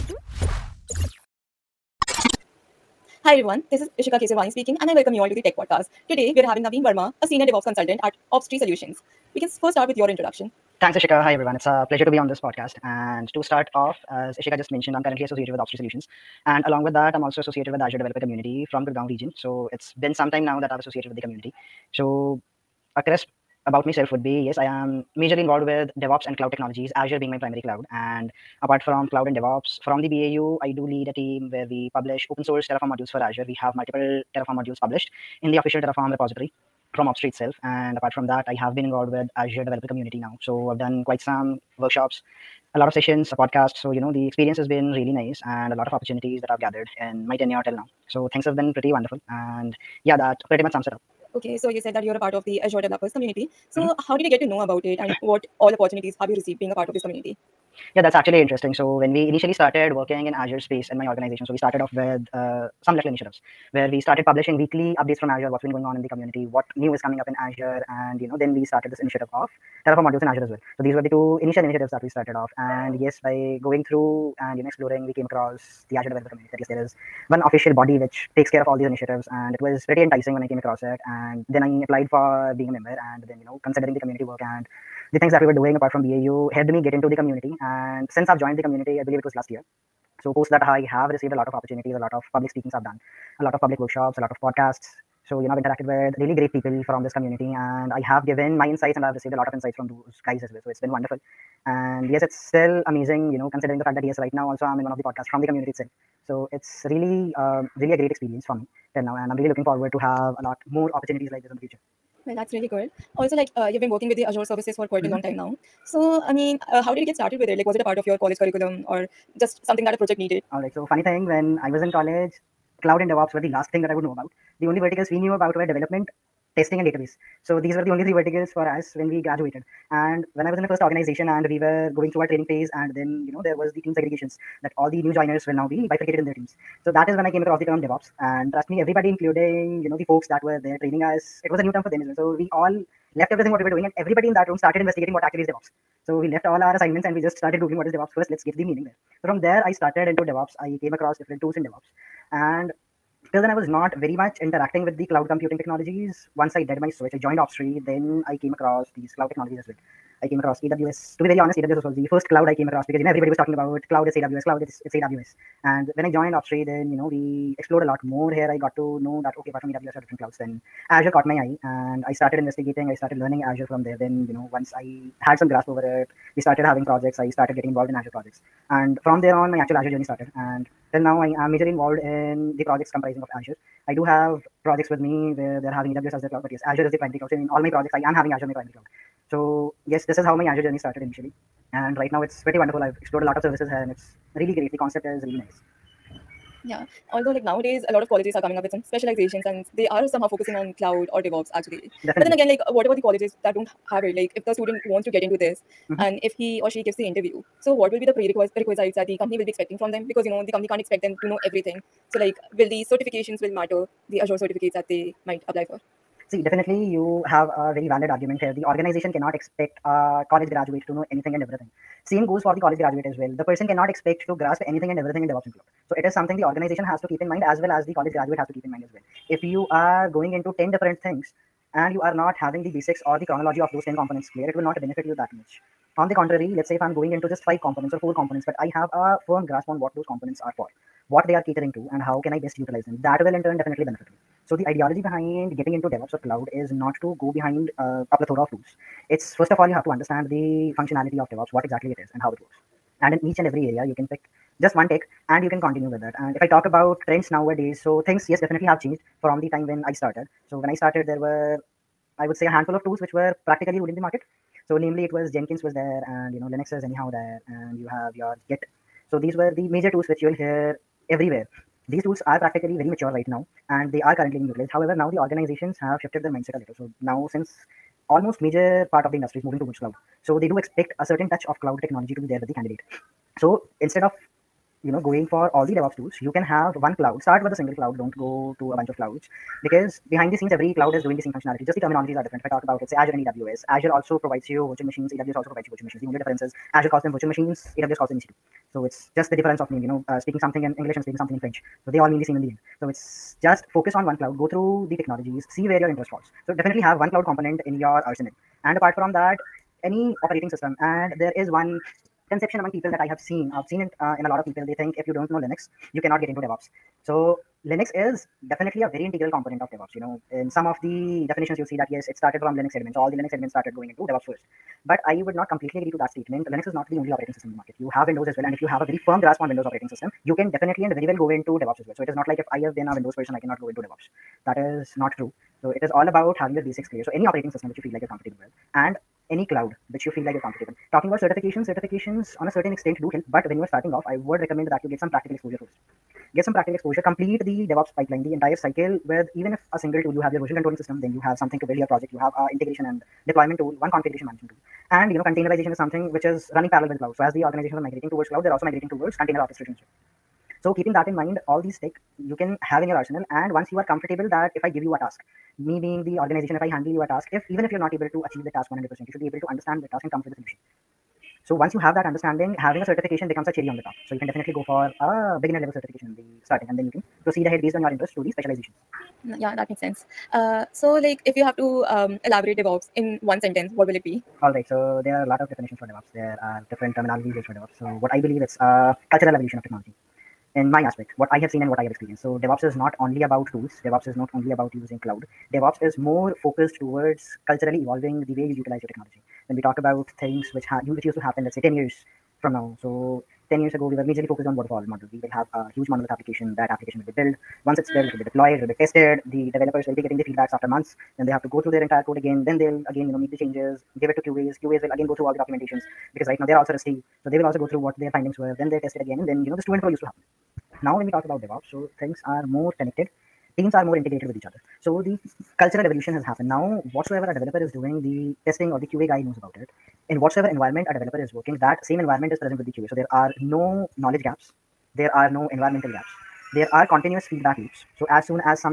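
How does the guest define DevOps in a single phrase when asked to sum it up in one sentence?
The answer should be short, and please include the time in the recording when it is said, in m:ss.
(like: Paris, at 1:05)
Cultural evolution of technology, at 6:29.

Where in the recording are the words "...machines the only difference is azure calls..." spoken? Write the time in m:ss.
4:55.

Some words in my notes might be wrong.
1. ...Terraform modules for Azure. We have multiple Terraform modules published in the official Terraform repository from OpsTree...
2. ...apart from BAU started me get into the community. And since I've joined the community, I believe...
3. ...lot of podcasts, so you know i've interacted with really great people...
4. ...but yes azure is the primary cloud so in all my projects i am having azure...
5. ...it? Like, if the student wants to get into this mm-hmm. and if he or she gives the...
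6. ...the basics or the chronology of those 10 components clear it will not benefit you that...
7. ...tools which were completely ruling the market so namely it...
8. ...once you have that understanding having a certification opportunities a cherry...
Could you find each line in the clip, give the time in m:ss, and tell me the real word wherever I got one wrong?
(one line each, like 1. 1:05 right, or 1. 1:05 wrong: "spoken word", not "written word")
1. 0:32 right
2. 1:25 wrong: "helped", not "started"
3. 1:34 right
4. 3:06 right
5. 3:24 right
6. 3:52 right
7. 4:22 wrong: "practically", not "completely"
8. 6:11 wrong: "becomes", not "opportunities".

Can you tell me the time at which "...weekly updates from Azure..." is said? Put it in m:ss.
1:04.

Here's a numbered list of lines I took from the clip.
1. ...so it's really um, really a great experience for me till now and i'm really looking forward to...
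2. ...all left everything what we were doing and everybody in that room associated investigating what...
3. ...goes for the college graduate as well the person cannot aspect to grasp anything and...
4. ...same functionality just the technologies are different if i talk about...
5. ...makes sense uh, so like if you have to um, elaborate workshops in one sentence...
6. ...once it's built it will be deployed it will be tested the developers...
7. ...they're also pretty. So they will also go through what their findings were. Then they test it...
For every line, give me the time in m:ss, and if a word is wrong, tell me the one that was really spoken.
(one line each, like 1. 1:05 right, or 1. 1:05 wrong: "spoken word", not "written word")
1. 1:46 right
2. 2:22 wrong: "started", not "associated"
3. 3:42 wrong: "expect", not "aspect"
4. 4:51 wrong: "terminologies", not "technologies"
5. 6:19 wrong: "devops", not "workshops"
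6. 6:47 right
7. 6:56 wrong: "rusty", not "pretty".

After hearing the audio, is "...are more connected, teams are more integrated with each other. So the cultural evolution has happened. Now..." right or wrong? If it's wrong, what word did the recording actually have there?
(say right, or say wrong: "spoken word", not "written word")
right.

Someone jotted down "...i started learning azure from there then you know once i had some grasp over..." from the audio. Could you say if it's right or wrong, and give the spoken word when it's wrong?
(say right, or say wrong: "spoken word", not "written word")
right.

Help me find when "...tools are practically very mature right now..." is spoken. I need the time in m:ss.
4:32.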